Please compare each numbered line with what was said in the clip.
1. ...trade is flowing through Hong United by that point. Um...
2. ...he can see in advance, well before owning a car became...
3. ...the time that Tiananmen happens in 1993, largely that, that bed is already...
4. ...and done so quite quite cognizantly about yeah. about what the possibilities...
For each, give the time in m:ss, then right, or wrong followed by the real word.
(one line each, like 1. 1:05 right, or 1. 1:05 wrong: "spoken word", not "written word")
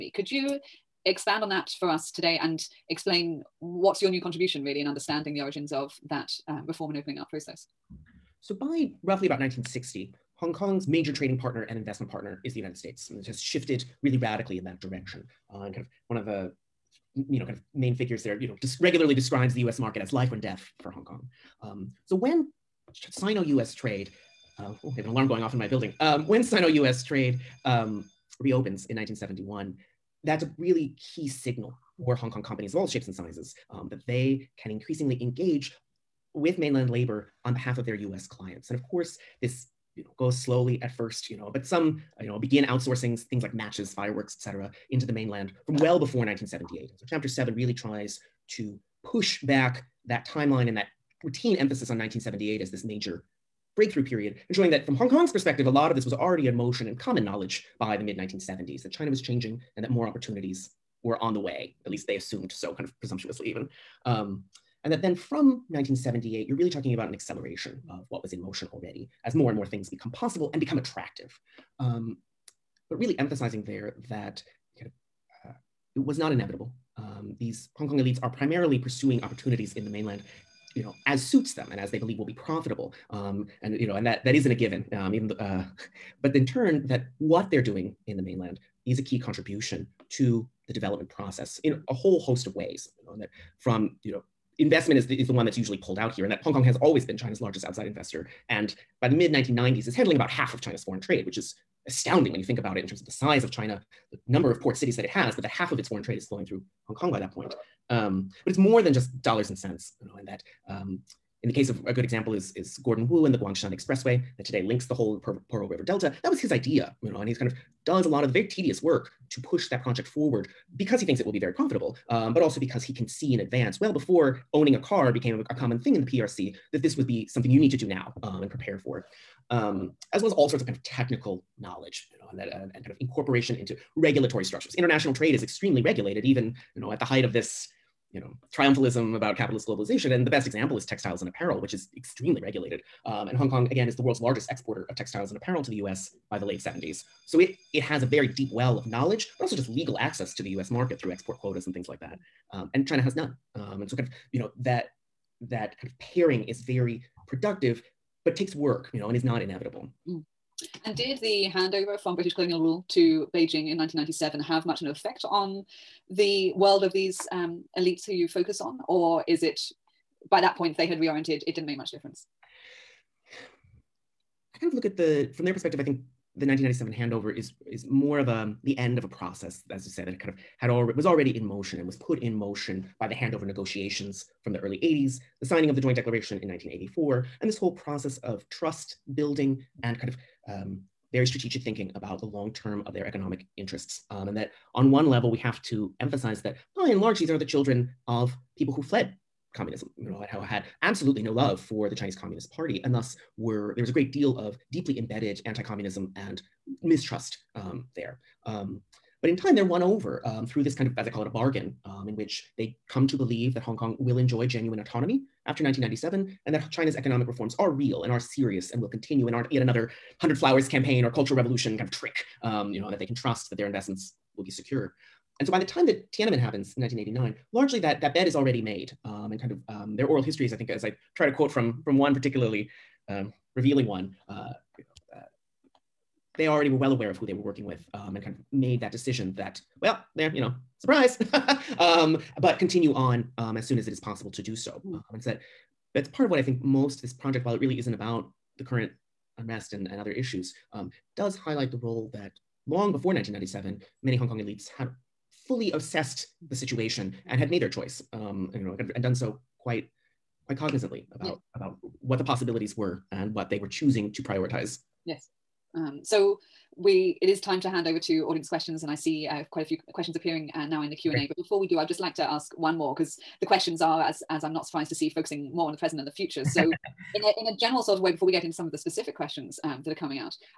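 1. 1:46 wrong: "Kong", not "United"
2. 2:02 right
3. 3:45 wrong: "1989", not "1993"
4. 4:18 right.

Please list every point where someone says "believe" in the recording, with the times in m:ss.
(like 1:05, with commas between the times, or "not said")
1:21, 3:33.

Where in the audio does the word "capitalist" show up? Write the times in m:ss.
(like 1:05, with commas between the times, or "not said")
2:19.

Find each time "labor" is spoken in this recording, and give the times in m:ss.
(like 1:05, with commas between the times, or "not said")
0:36.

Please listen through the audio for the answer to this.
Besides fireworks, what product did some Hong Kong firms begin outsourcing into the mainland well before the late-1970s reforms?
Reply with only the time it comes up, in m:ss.
0:43.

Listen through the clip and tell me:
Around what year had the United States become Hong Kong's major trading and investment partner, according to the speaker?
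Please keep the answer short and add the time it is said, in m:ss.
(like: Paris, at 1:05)
1960, at 0:09.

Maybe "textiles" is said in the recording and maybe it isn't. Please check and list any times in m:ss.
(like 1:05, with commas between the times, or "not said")
2:20, 2:24.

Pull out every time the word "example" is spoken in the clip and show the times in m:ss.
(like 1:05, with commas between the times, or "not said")
1:52, 2:20.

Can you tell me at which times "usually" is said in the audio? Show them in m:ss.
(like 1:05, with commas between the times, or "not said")
1:35.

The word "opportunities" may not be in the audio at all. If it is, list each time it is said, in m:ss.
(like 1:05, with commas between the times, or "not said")
1:00, 1:19.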